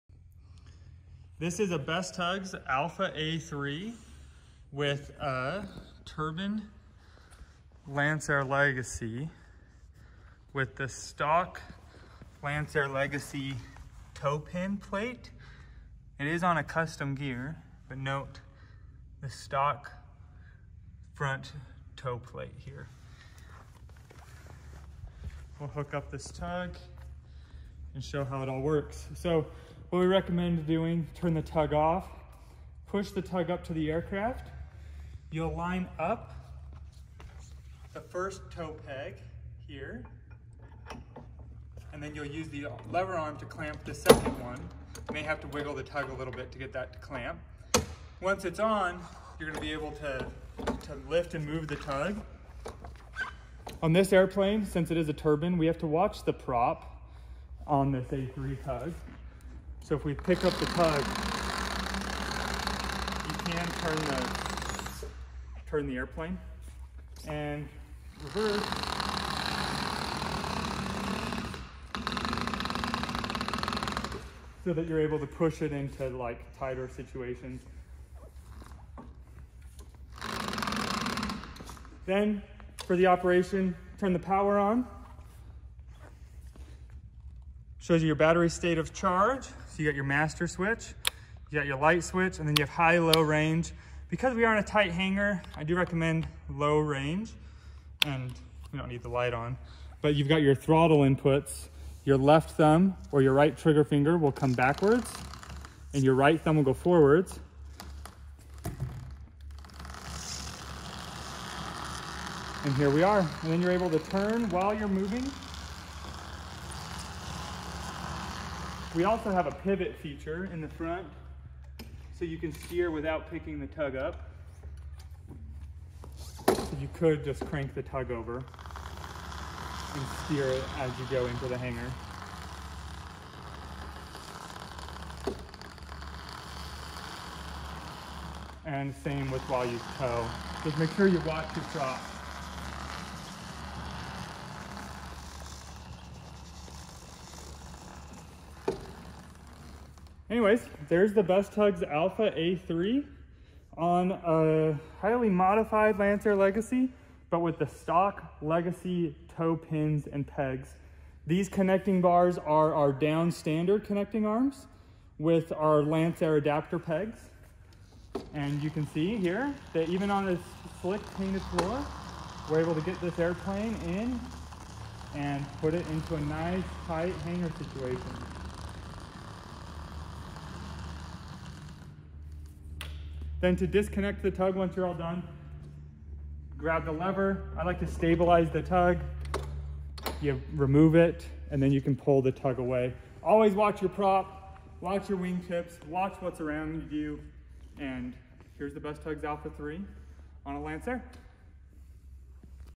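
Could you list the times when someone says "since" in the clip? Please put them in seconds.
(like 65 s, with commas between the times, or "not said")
54 s.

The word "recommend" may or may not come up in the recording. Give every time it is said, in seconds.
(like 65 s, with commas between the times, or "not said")
30 s, 95 s.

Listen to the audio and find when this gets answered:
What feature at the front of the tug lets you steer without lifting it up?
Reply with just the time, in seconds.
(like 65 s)
119 s.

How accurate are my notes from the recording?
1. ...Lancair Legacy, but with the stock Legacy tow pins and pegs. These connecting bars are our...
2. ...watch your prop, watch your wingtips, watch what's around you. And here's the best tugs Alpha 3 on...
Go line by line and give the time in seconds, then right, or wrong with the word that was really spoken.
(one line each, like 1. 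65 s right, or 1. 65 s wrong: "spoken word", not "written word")
1. 155 s right
2. 193 s right.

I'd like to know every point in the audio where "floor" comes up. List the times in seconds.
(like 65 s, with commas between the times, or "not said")
171 s.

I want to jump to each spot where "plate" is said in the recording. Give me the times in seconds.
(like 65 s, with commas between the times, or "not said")
14 s, 22 s.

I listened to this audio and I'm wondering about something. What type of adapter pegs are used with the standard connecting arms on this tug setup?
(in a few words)
Lancair adapter pegs.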